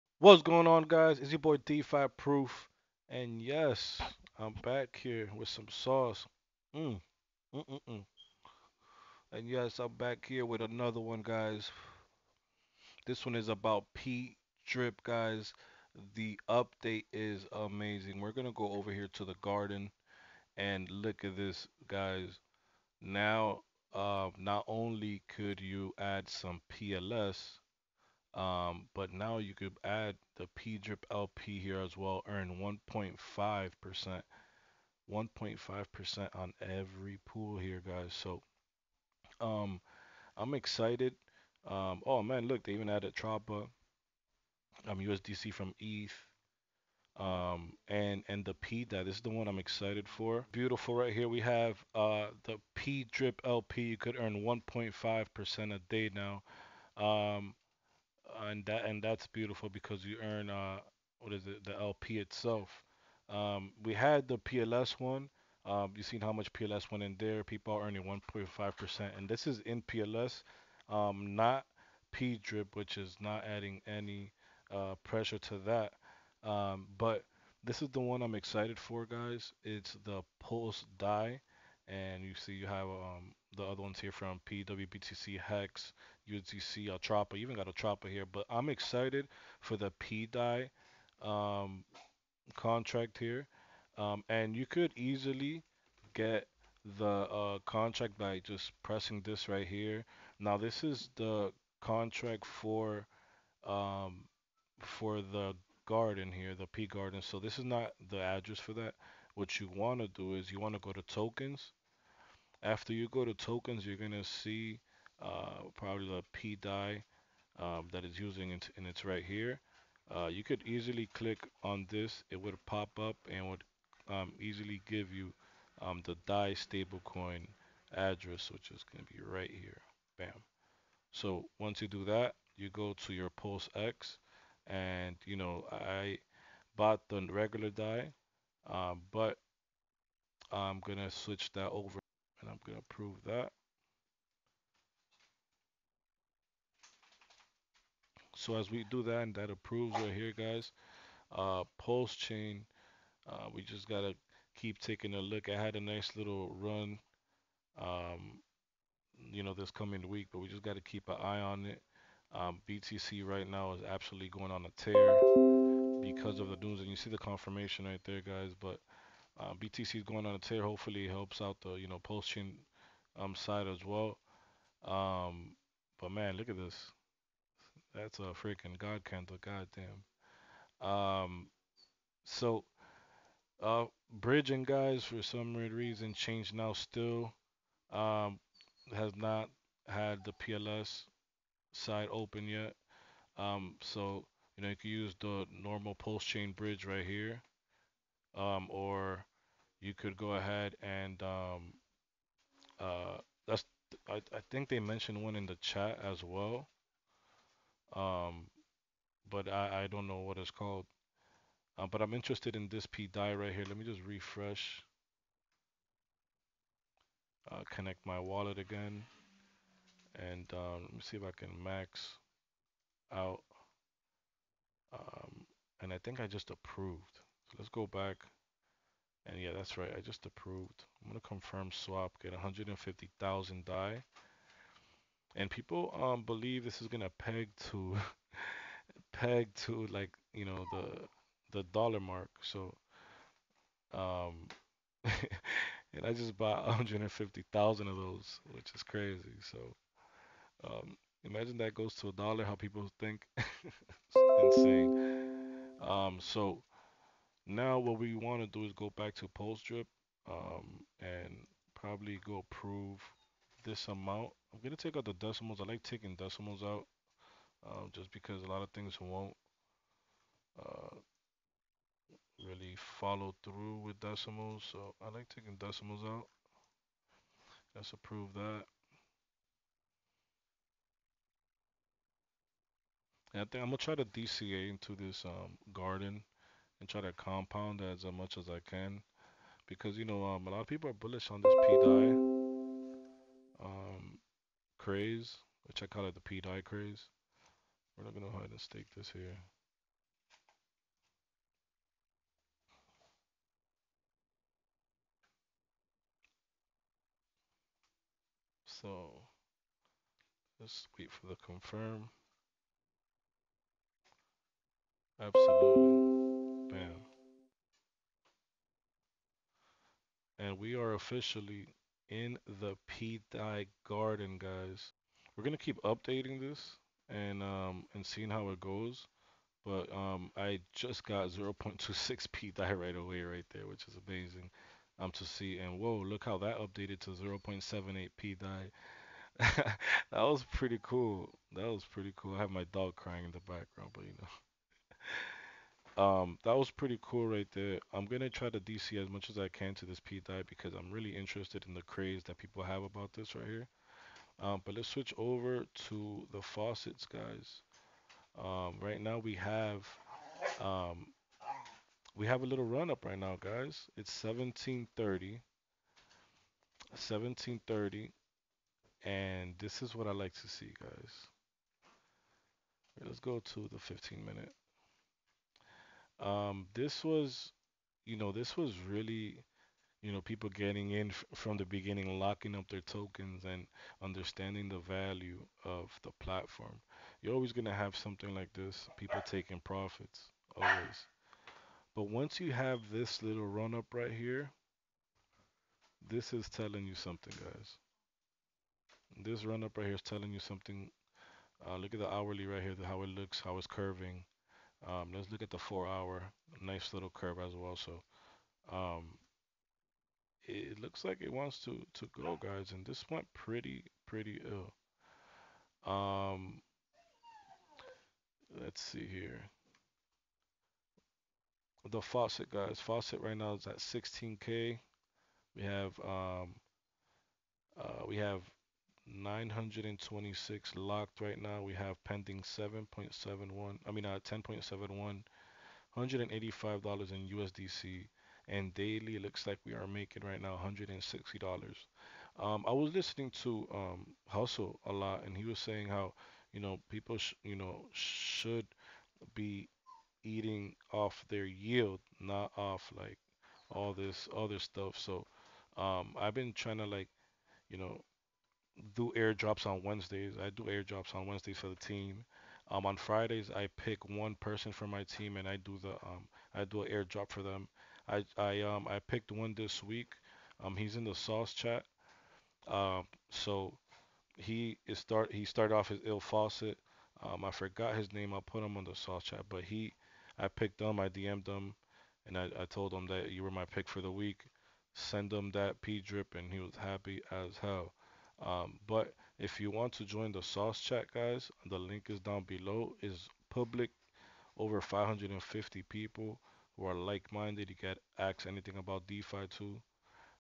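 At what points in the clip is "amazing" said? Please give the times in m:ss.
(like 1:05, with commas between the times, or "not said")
0:17, 5:34.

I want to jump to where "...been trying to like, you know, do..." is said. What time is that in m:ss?
7:36.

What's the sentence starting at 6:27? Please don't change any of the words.
You're always gonna have something like this.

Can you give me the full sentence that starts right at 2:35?
I had a nice little run, um, you know, this coming week, but we just got to keep an eye on it.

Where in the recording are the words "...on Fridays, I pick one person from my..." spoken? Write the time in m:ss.
7:42.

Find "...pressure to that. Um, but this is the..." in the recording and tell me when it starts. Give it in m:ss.
1:15.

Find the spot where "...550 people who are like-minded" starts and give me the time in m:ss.
8:14.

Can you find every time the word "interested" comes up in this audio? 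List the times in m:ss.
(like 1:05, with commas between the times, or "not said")
3:32, 5:51.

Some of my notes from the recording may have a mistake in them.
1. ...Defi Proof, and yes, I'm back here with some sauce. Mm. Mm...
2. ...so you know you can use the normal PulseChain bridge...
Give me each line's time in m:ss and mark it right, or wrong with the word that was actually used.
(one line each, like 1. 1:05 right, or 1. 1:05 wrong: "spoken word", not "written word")
1. 0:01 right
2. 3:13 right.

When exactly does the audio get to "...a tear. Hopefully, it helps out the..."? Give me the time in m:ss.
2:50.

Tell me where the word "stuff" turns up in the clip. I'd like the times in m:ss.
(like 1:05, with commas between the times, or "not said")
7:34.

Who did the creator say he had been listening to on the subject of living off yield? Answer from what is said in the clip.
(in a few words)
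Hustle.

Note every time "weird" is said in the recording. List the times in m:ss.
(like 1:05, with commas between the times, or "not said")
3:05.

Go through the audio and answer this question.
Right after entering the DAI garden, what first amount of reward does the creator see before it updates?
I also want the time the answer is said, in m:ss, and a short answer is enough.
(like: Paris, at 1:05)
0.26 P-DAI, at 5:31.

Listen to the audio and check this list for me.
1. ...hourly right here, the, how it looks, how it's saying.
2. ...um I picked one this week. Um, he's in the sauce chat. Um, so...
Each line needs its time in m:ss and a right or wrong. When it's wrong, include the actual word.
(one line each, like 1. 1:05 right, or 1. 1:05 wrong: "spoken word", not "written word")
1. 6:42 wrong: "curving", not "saying"
2. 7:48 right.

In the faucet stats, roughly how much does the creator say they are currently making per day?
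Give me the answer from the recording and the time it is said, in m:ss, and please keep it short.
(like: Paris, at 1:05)
$160, at 7:20.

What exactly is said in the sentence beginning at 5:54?
Um, but let's switch over to the faucets, guys.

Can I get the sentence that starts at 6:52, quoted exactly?
And this went pretty, pretty ill.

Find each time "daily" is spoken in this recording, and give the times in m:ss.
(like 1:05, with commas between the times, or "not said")
7:18.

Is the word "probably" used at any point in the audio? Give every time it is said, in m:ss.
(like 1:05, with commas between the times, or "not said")
1:55, 4:21.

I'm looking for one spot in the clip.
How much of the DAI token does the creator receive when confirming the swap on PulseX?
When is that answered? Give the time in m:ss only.
3:52.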